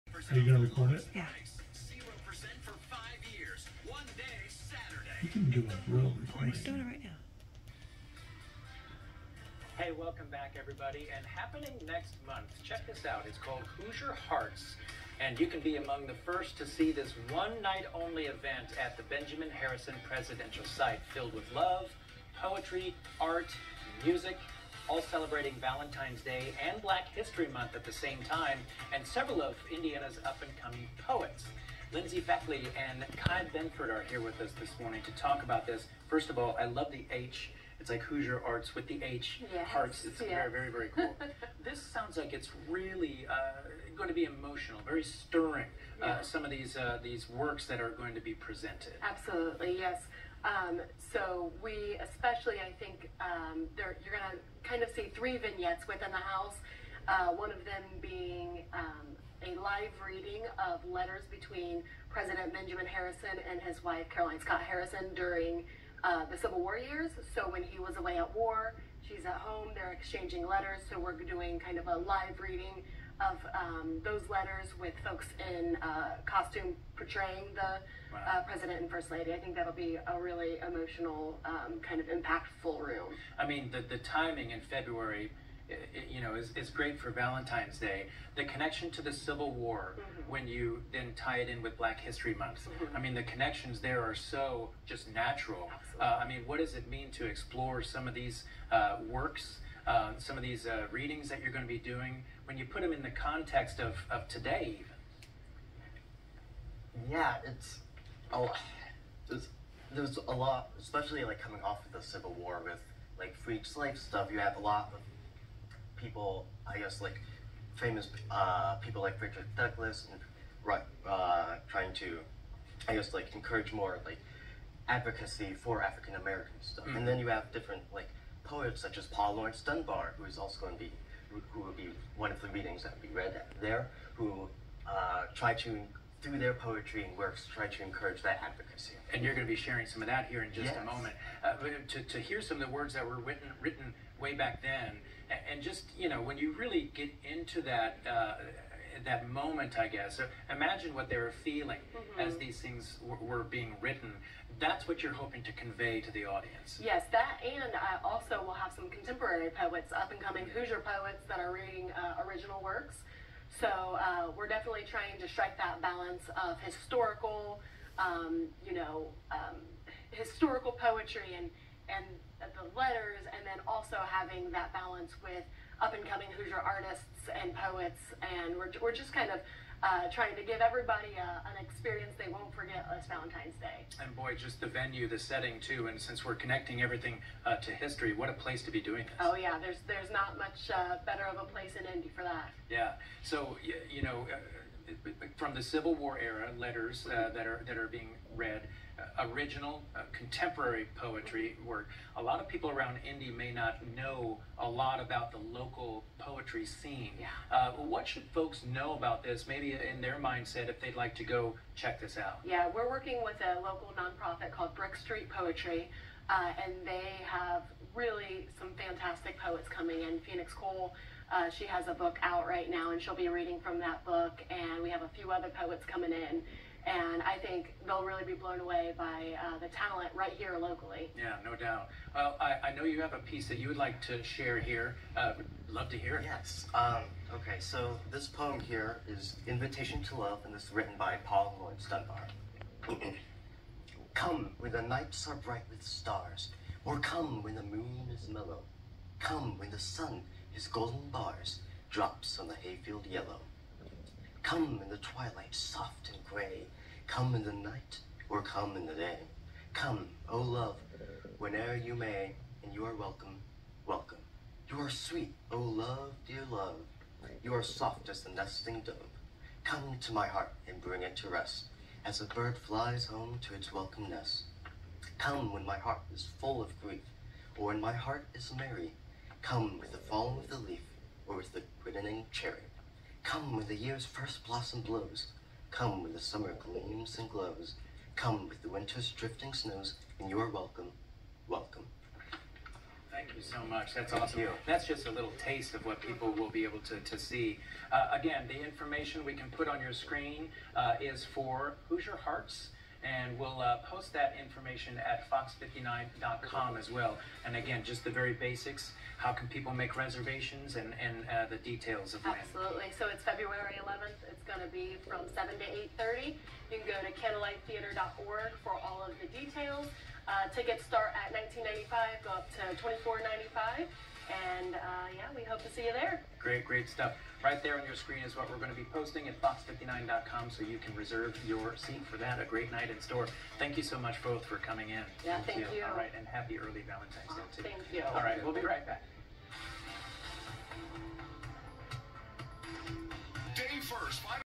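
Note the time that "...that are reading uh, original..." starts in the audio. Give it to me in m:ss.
2:41.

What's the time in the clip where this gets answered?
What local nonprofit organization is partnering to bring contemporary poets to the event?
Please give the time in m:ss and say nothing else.
3:34.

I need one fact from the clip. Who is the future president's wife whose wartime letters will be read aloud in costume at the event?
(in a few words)
Caroline Scott Harrison.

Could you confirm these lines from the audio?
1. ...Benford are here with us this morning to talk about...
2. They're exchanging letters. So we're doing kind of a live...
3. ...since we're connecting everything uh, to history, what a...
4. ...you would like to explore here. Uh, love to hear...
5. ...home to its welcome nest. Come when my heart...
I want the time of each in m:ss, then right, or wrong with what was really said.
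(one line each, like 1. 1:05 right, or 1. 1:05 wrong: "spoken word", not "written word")
1. 0:33 right
2. 1:09 right
3. 3:05 right
4. 3:53 wrong: "share", not "explore"
5. 4:33 right.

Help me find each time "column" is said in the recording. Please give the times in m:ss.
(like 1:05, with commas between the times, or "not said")
not said.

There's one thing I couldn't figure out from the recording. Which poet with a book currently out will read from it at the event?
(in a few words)
Phoenix Cole.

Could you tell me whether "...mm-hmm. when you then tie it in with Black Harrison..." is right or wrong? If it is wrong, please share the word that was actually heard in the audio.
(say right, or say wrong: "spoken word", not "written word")
wrong: "History", not "Harrison".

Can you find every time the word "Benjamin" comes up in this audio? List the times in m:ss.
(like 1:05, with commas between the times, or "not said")
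0:19, 1:02.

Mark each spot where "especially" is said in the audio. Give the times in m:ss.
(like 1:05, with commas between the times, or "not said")
0:52, 1:50.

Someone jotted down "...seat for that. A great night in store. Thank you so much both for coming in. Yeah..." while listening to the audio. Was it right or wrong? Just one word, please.
right.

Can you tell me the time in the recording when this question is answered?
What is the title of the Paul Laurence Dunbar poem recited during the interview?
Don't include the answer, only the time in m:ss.
3:59.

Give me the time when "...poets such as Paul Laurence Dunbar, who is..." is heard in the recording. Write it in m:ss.
2:08.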